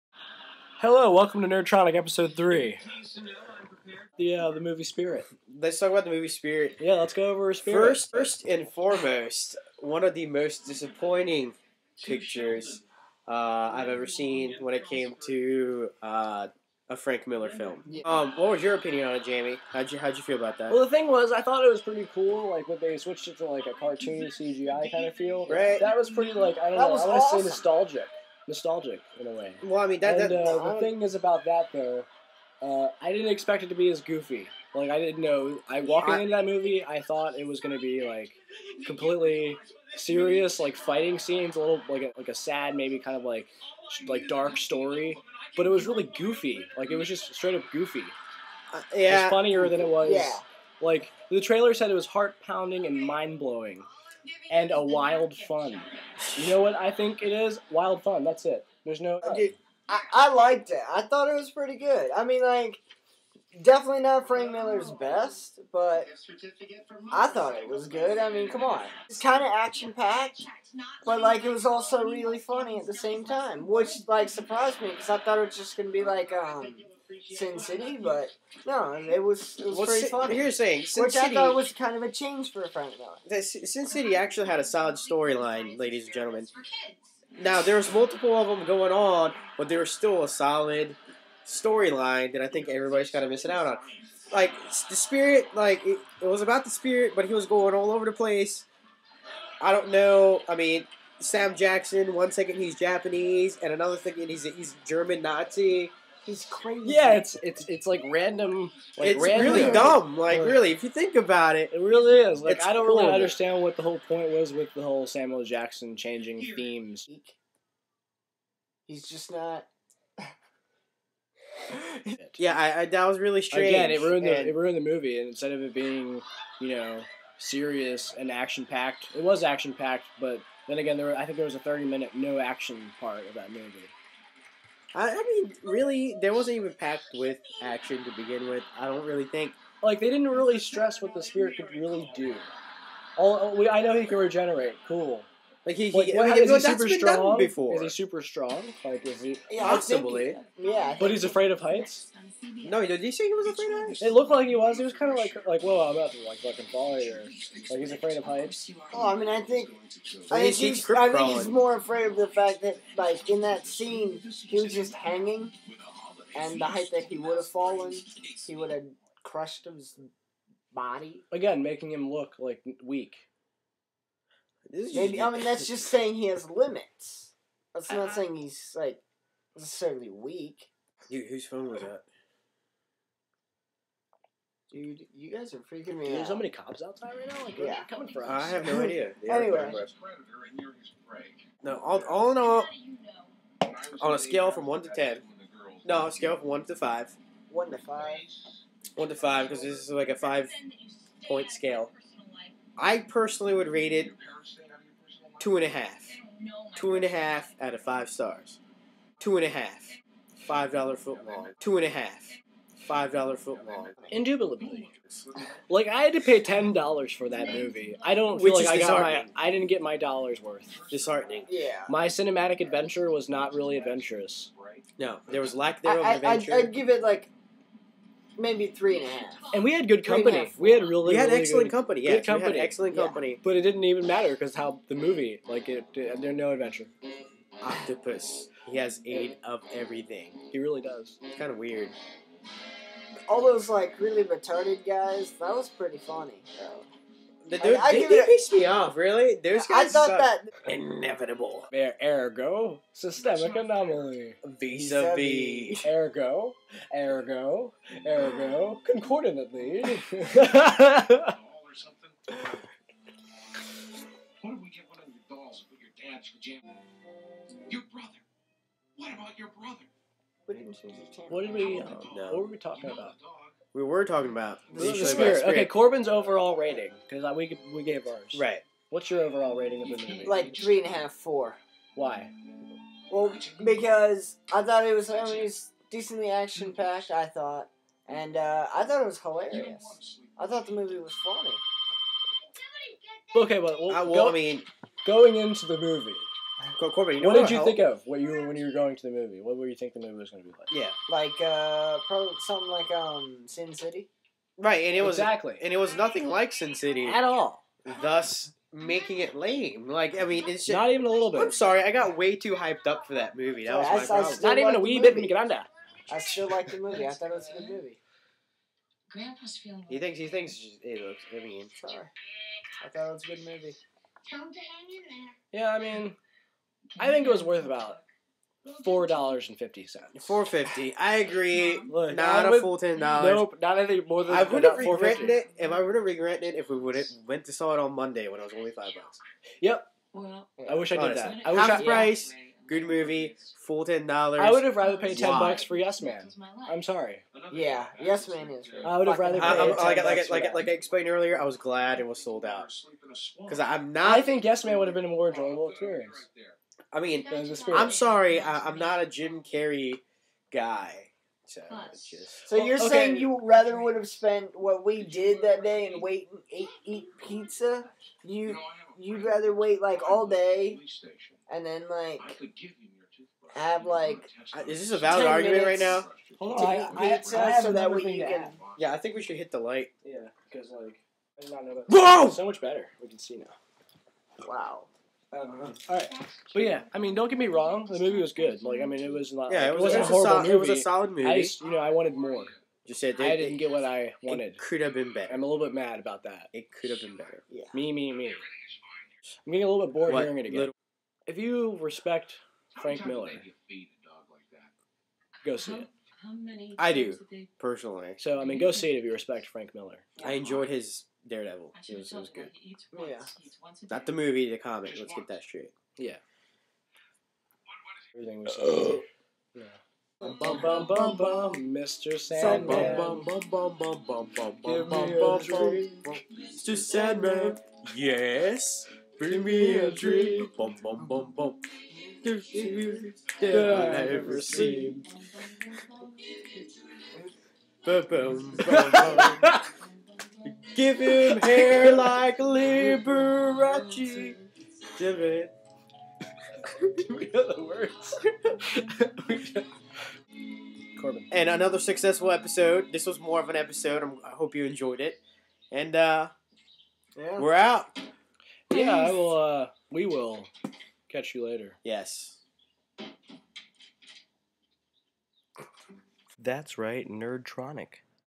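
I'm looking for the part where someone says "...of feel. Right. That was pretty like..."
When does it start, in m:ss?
0:25.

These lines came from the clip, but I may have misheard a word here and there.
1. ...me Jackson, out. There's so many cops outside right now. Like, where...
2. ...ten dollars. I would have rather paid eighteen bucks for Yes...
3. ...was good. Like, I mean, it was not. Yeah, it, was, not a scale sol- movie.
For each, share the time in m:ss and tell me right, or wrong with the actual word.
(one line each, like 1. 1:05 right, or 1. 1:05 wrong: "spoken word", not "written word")
1. 3:05 wrong: "Dude", not "Jackson"
2. 5:43 wrong: "ten", not "eighteen"
3. 6:28 wrong: "horrible", not "scale".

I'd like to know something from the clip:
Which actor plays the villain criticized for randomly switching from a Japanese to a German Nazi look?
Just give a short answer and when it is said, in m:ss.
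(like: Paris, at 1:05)
Sam Jackson, at 1:41.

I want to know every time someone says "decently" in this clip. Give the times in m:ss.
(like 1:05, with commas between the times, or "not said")
4:45.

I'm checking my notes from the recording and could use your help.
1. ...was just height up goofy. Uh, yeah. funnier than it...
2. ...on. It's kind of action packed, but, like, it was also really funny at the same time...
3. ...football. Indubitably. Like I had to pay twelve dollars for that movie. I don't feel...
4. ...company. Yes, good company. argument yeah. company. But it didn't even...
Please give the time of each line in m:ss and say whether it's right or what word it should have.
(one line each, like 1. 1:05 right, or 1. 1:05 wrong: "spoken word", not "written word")
1. 0:46 wrong: "straight", not "height"
2. 1:08 right
3. 3:33 wrong: "ten", not "twelve"
4. 3:51 wrong: "excellent", not "argument".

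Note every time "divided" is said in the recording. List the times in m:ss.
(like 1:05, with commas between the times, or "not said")
not said.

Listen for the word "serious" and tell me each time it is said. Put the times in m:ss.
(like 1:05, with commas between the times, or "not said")
0:39, 2:07.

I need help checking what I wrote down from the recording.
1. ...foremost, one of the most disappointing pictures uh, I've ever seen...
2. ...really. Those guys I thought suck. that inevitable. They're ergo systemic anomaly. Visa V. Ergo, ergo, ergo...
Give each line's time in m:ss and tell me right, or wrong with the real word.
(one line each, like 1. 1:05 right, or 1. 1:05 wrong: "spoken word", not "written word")
1. 0:08 right
2. 4:08 right.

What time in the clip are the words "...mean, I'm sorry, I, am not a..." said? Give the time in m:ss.
5:56.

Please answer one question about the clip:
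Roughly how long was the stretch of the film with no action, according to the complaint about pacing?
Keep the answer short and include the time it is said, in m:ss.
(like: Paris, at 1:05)
30 minutes, at 2:11.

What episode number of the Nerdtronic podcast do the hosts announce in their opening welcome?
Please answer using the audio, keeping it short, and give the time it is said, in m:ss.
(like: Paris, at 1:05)
3, at 0:01.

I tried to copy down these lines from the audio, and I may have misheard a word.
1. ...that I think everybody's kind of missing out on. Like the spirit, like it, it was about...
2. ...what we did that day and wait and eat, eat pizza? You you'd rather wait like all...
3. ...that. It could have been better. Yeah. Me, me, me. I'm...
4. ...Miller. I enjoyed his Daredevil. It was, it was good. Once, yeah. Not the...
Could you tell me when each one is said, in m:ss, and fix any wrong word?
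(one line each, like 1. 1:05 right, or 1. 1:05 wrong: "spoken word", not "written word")
1. 1:32 right
2. 6:04 right
3. 6:36 right
4. 6:49 right.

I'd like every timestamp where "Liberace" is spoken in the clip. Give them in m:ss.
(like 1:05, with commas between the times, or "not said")
7:22.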